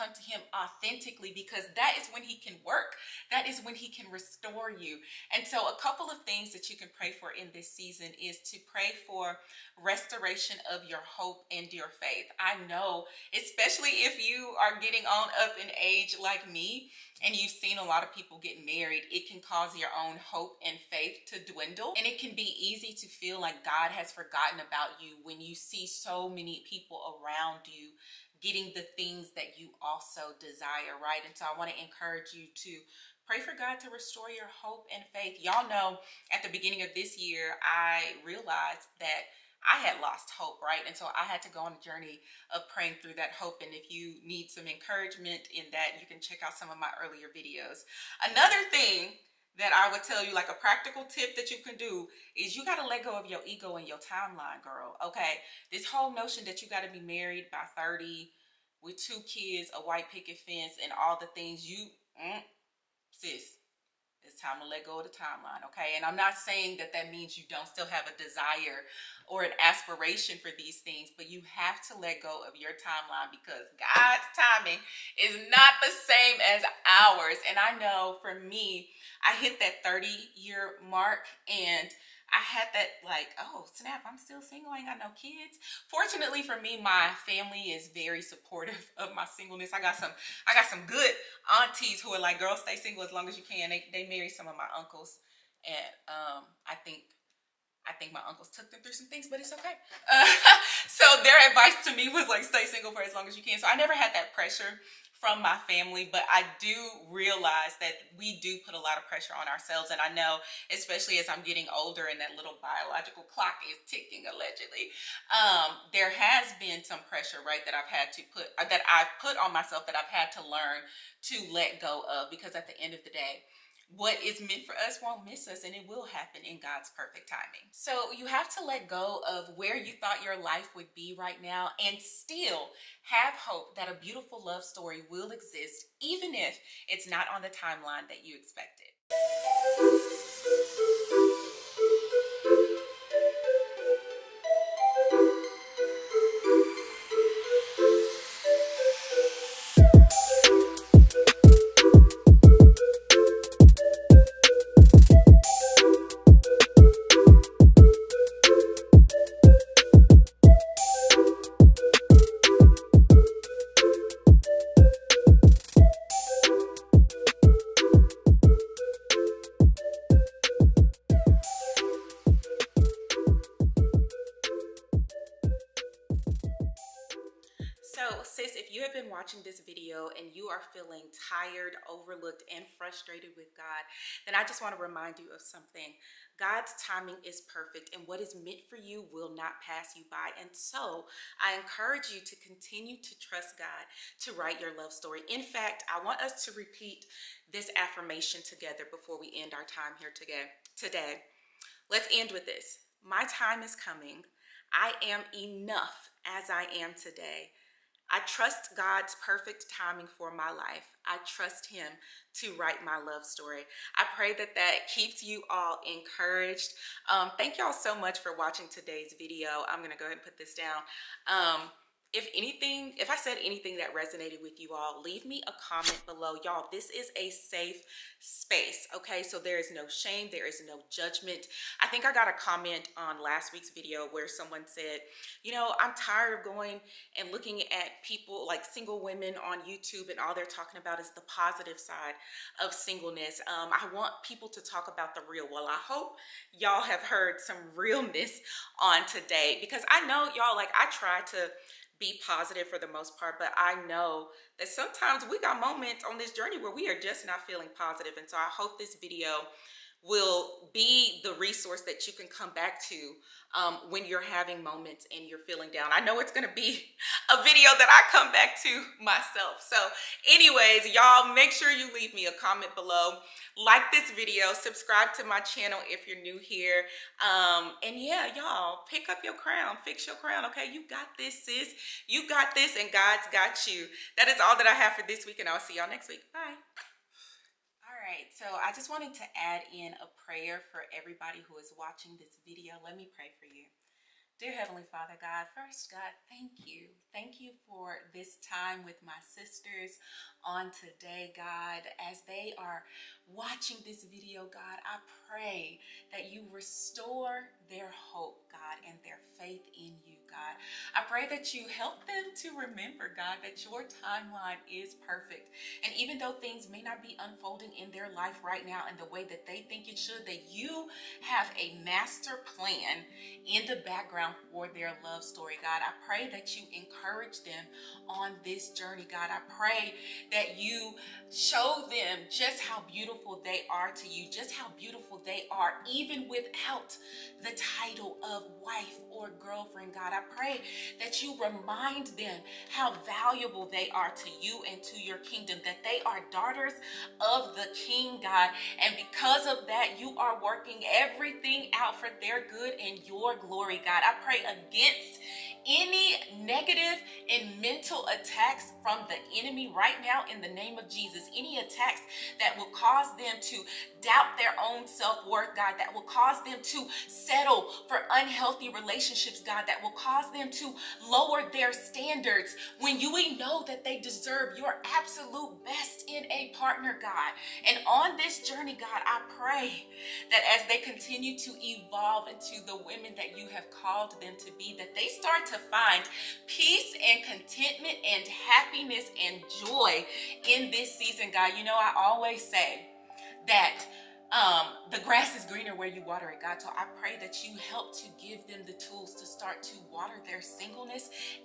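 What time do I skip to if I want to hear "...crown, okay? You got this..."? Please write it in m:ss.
4:40.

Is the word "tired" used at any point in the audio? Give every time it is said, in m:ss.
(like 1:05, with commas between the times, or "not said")
3:01, 3:55.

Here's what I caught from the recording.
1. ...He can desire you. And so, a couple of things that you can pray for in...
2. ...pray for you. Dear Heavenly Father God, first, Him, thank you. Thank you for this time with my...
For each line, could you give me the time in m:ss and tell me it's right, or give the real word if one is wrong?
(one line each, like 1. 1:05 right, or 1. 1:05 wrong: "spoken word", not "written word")
1. 0:03 wrong: "restore", not "desire"
2. 4:53 wrong: "God", not "Him".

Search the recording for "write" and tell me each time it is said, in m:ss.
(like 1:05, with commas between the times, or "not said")
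3:14, 3:32.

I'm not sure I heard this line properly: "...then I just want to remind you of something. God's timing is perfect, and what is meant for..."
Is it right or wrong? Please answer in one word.
right.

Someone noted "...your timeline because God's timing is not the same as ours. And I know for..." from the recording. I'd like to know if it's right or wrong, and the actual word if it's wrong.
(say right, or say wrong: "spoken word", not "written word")
right.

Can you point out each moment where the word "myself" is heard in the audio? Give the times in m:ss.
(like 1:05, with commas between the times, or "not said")
1:59, 4:29.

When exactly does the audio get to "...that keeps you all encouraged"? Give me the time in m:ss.
3:34.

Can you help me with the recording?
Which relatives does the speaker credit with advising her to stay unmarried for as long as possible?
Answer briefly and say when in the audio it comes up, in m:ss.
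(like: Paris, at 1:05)
aunties, at 1:31.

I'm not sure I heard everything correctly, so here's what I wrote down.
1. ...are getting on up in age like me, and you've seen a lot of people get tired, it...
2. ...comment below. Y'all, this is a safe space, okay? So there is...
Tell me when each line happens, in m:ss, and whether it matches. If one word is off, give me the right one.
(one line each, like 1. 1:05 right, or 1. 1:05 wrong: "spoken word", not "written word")
1. 0:14 wrong: "married", not "tired"
2. 3:45 right.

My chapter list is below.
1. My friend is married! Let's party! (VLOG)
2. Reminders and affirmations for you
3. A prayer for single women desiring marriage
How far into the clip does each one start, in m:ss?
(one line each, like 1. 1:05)
1. 2:18
2. 2:56
3. 4:48.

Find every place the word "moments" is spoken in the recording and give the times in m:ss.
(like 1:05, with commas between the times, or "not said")
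4:15, 4:24.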